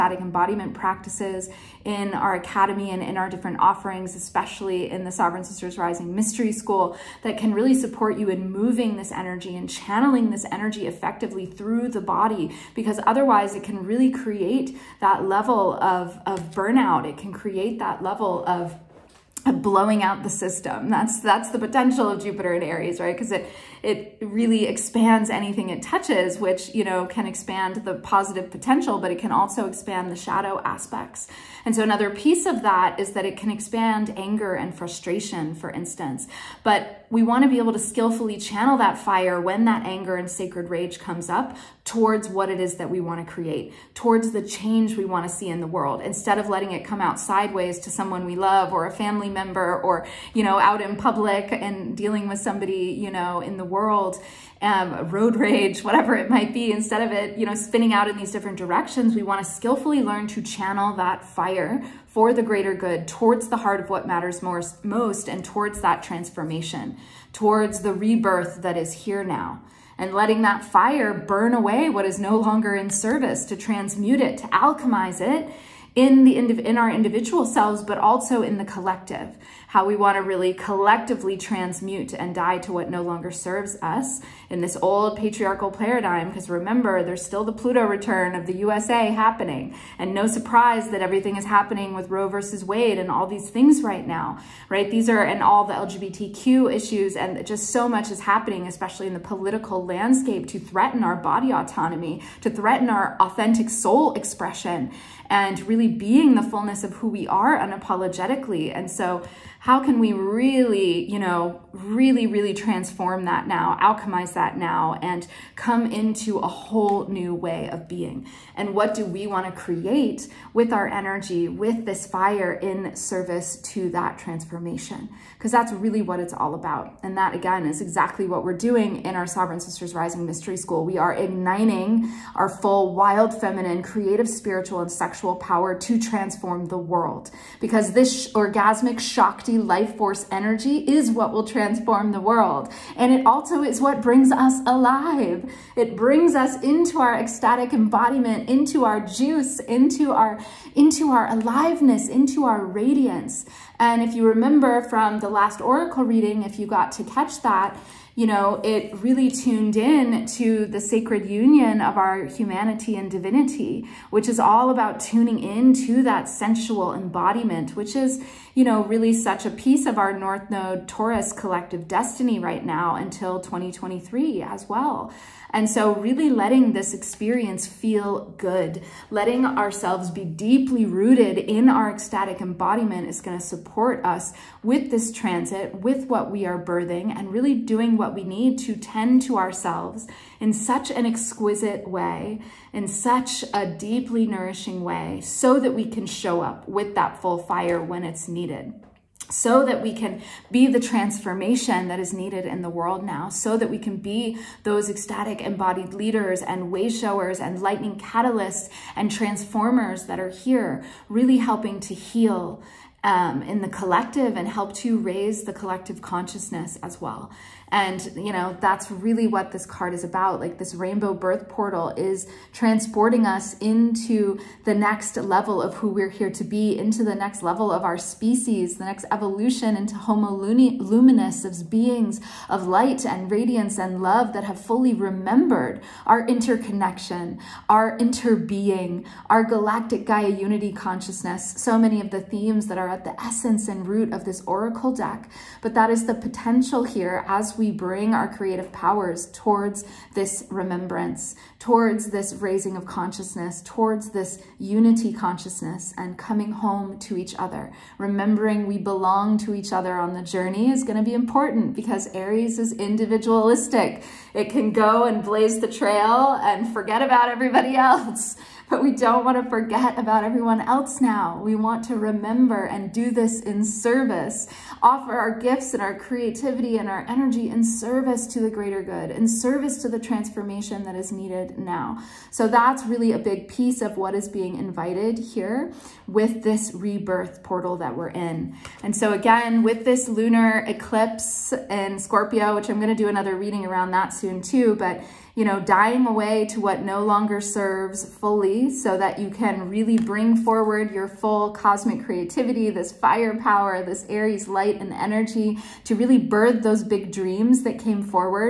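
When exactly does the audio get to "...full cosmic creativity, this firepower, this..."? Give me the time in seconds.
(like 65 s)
301 s.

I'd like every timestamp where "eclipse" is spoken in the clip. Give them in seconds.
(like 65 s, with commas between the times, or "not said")
290 s.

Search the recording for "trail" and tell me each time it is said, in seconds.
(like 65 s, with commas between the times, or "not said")
265 s.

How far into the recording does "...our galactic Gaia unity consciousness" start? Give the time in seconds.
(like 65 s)
239 s.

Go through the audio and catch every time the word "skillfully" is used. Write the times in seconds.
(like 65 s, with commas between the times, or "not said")
37 s, 59 s.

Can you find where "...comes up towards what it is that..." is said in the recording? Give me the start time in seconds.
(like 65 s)
40 s.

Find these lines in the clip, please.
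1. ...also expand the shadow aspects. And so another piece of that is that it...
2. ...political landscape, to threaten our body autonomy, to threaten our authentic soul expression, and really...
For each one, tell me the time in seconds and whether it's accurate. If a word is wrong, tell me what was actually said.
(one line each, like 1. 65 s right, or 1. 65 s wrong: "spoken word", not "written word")
1. 29 s right
2. 99 s right.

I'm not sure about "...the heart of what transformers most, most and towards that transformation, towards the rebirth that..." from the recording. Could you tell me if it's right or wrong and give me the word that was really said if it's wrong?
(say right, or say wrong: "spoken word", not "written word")
wrong: "matters", not "transformers".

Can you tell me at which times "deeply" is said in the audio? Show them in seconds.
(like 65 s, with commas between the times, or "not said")
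180 s, 193 s.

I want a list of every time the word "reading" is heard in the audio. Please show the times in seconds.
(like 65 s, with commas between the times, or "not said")
156 s, 293 s.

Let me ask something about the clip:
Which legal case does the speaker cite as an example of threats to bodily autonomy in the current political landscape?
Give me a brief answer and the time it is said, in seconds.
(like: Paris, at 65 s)
Roe versus Wade, at 92 s.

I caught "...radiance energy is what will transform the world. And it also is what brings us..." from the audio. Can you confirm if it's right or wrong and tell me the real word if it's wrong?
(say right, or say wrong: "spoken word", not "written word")
wrong: "force", not "radiance".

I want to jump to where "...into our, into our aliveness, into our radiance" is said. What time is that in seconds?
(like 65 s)
149 s.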